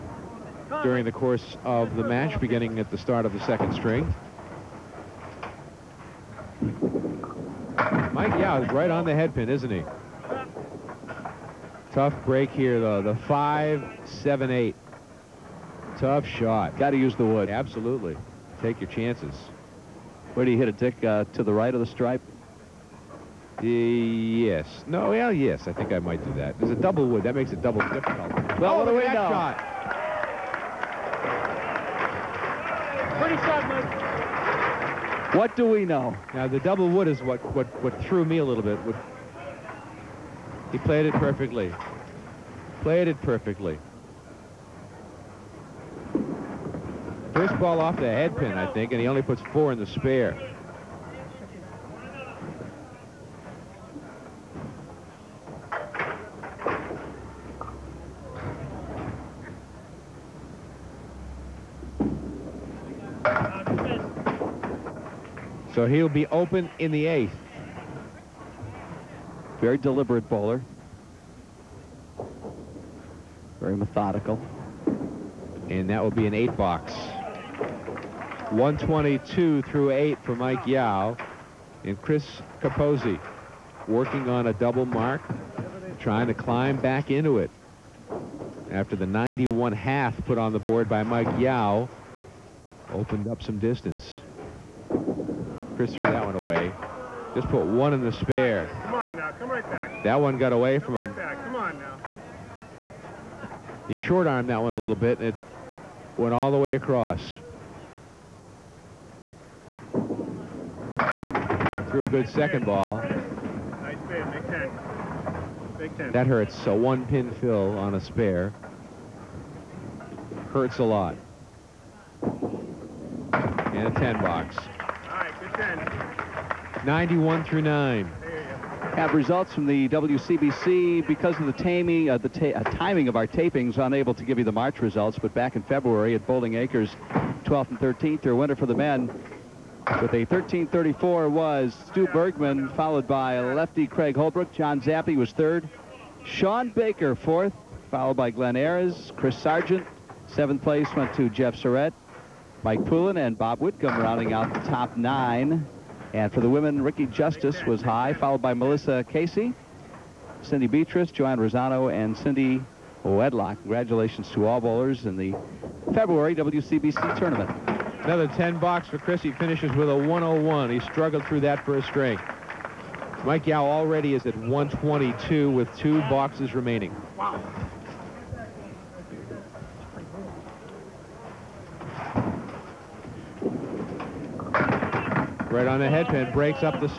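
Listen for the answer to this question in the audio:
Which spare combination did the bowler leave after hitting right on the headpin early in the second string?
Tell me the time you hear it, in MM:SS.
00:13.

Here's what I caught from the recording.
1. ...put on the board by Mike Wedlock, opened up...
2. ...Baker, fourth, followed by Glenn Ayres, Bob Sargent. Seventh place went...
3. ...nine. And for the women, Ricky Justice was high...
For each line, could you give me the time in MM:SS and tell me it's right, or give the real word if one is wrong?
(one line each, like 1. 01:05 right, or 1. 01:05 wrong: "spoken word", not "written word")
1. 01:30 wrong: "Yow", not "Wedlock"
2. 02:26 wrong: "Chris", not "Bob"
3. 02:34 right.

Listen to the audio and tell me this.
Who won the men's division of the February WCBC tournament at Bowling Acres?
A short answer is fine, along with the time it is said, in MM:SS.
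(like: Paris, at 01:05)
Stu Bergman, at 02:21.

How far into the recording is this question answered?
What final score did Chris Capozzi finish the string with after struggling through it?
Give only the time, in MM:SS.
02:49.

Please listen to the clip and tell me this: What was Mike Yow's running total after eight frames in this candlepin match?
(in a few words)
122.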